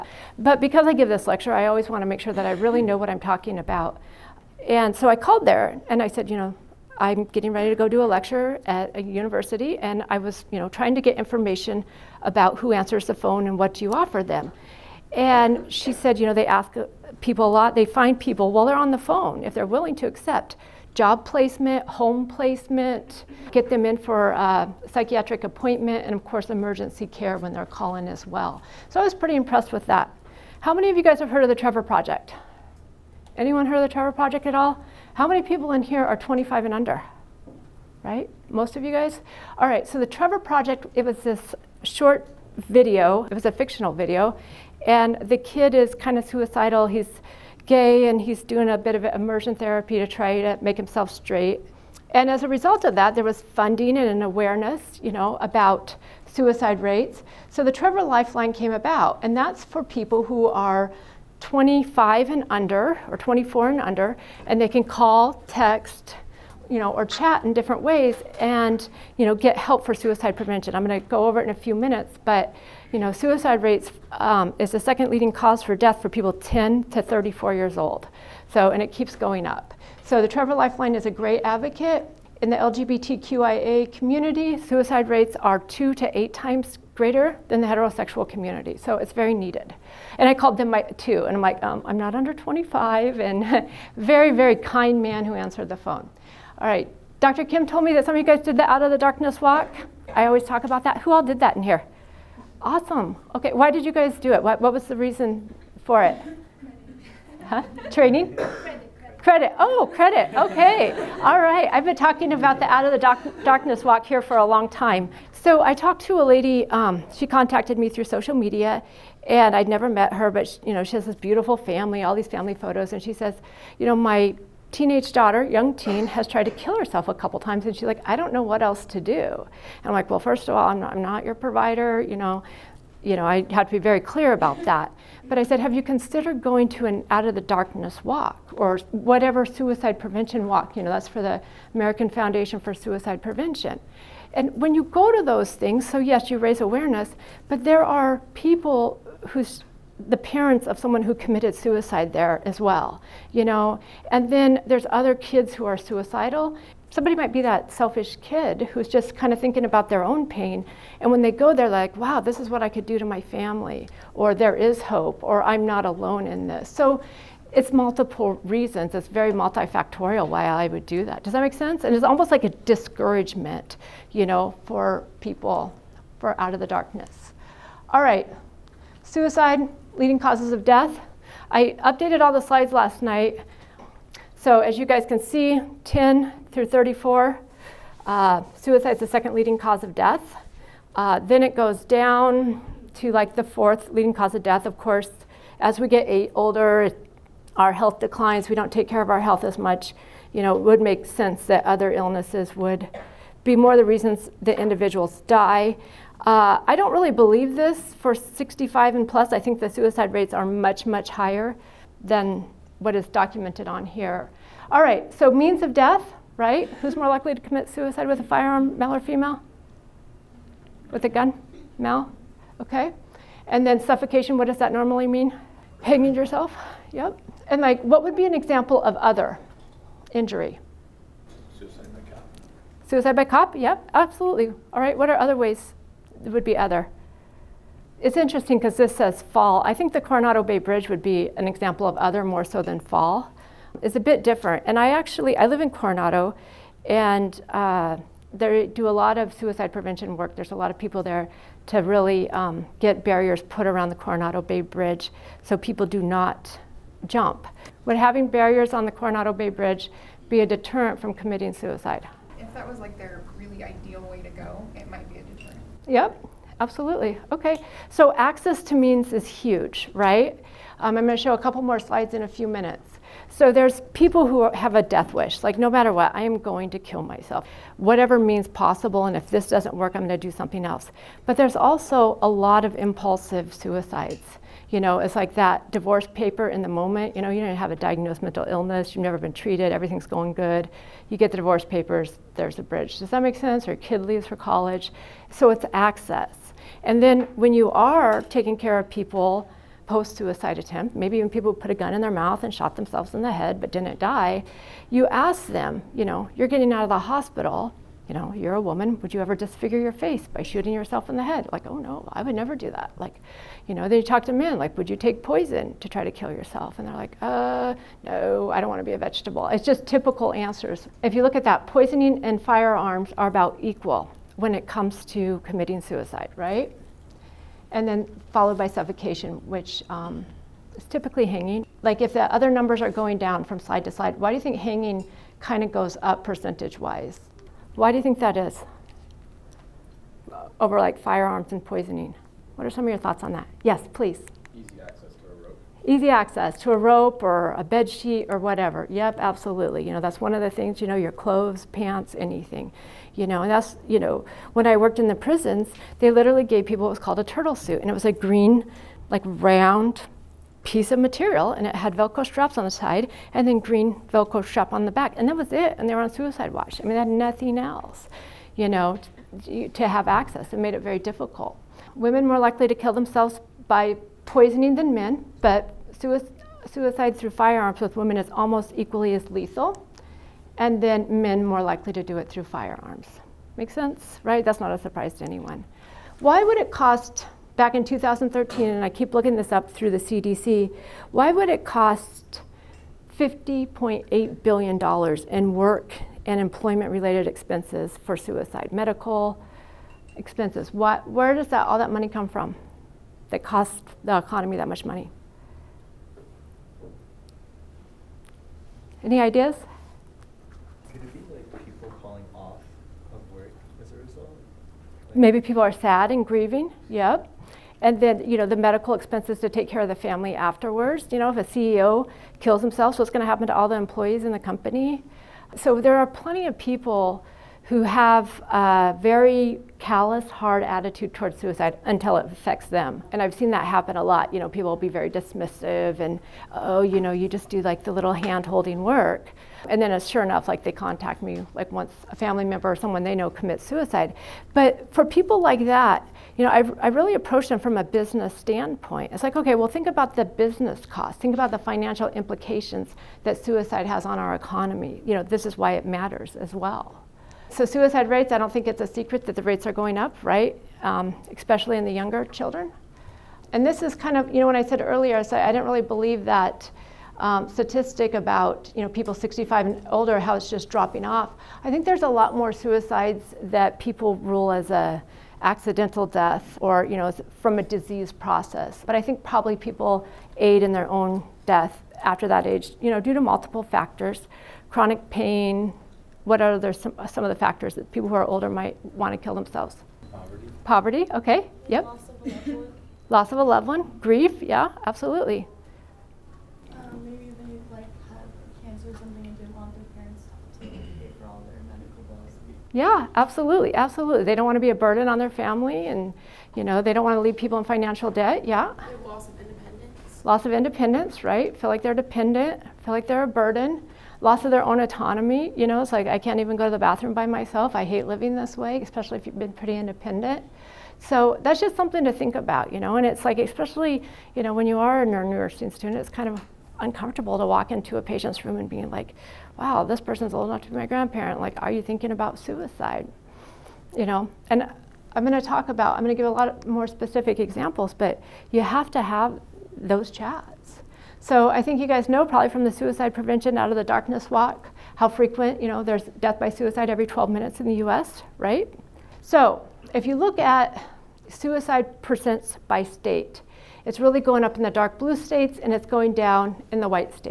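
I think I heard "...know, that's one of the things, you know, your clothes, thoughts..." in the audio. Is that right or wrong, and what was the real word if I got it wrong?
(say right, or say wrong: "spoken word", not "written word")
wrong: "pants", not "thoughts".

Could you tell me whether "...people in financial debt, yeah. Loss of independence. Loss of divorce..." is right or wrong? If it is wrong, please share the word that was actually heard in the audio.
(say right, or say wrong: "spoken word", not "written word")
wrong: "independence", not "divorce".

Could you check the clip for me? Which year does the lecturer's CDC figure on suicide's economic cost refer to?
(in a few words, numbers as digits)
2013.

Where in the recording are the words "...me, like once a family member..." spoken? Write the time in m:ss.
7:21.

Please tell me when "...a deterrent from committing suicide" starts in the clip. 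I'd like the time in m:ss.
4:20.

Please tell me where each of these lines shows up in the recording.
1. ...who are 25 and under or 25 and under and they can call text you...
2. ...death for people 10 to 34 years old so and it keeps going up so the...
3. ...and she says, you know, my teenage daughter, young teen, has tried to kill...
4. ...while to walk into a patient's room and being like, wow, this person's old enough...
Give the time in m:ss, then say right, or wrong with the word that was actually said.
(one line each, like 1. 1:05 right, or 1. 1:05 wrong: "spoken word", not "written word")
1. 1:00 wrong: "24", not "25"
2. 1:15 right
3. 2:02 right
4. 8:46 wrong: "uncomfortable", not "while".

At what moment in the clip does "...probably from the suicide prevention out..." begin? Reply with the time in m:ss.
9:02.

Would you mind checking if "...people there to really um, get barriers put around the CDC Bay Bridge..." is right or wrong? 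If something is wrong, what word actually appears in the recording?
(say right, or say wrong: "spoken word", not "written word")
wrong: "Coronado", not "CDC".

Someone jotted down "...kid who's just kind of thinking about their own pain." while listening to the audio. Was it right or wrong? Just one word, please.
right.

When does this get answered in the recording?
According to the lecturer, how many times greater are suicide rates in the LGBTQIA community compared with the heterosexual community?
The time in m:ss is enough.
1:25.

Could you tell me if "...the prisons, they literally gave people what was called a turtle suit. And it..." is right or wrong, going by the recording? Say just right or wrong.
right.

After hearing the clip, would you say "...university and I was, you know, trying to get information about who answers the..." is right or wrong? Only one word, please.
right.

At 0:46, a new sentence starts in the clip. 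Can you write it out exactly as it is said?
He's gay and he's doing a bit of immersion therapy to try to make himself straight.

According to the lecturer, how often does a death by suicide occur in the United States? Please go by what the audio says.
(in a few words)
Every 12 minutes.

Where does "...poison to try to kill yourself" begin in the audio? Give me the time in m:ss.
5:15.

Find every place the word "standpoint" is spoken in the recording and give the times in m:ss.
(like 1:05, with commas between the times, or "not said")
7:28.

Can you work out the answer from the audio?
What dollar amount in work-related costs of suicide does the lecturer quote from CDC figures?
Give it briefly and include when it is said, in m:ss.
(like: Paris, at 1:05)
$50.8 billion, at 6:33.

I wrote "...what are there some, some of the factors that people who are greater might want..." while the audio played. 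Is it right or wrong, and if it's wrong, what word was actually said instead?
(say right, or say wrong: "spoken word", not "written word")
wrong: "older", not "greater".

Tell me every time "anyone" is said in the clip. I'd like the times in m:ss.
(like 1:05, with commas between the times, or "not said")
0:33, 6:25.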